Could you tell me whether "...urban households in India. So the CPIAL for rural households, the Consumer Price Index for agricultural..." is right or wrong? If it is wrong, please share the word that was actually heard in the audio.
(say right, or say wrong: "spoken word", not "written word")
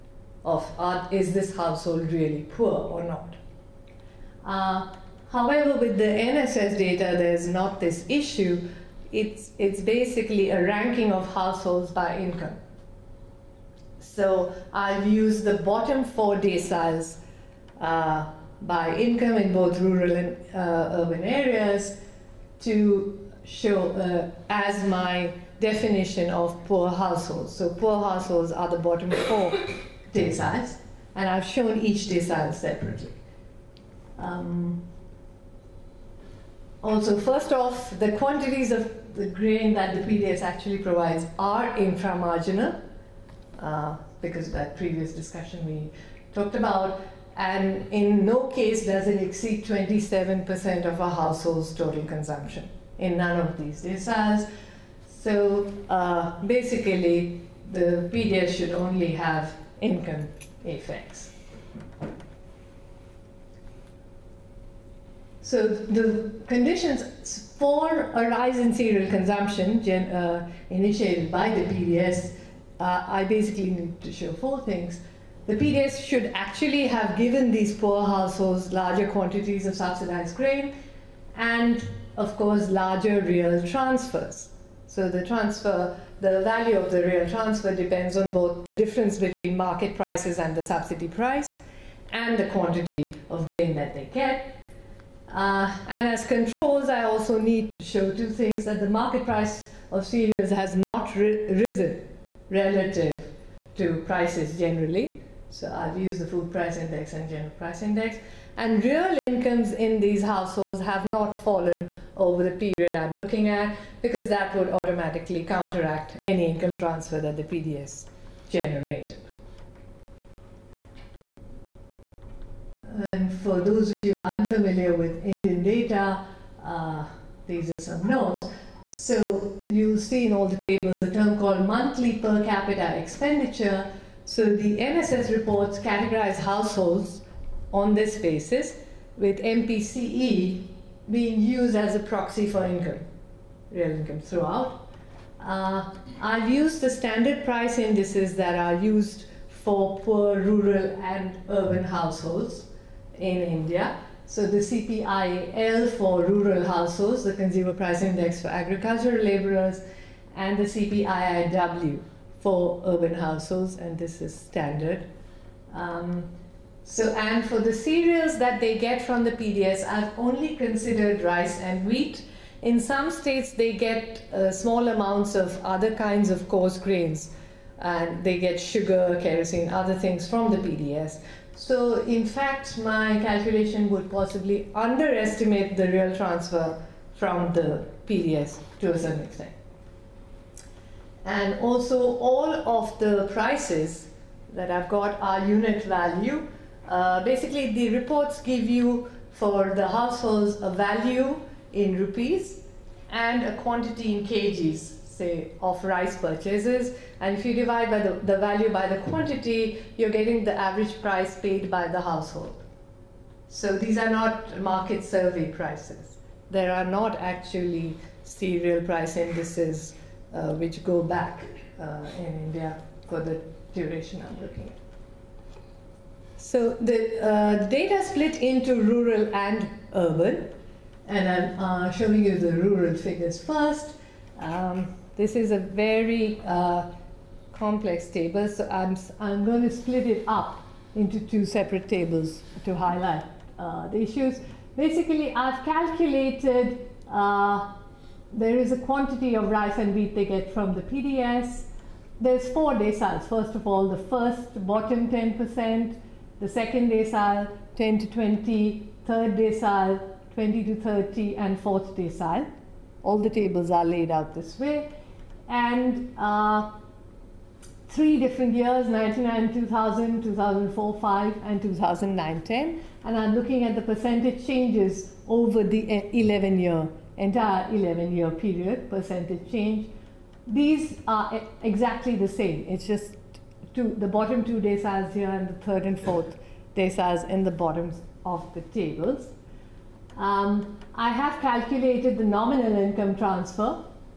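right.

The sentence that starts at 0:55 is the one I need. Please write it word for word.
So uh, basically, the PDS should only have income effects.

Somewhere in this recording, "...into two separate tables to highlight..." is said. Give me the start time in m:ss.
4:00.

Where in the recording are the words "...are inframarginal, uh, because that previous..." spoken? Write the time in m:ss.
0:41.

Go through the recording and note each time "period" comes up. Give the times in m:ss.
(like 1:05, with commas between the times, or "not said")
1:52, 4:38.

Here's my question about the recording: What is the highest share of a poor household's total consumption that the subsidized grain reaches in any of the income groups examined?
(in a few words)
27%.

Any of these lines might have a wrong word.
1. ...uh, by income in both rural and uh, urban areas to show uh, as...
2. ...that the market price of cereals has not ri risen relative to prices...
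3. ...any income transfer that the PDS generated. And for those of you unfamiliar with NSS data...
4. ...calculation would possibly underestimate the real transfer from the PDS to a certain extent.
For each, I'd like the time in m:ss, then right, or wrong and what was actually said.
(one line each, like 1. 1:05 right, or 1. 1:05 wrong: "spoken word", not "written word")
1. 0:17 right
2. 1:38 right
3. 1:56 wrong: "Indian", not "NSS"
4. 3:03 right.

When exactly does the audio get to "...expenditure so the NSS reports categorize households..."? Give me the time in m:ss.
2:12.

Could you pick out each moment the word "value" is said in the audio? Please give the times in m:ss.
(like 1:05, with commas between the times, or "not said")
1:26, 3:15, 3:20, 3:28.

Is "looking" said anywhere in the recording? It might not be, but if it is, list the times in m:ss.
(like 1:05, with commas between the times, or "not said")
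1:53, 3:44, 4:33.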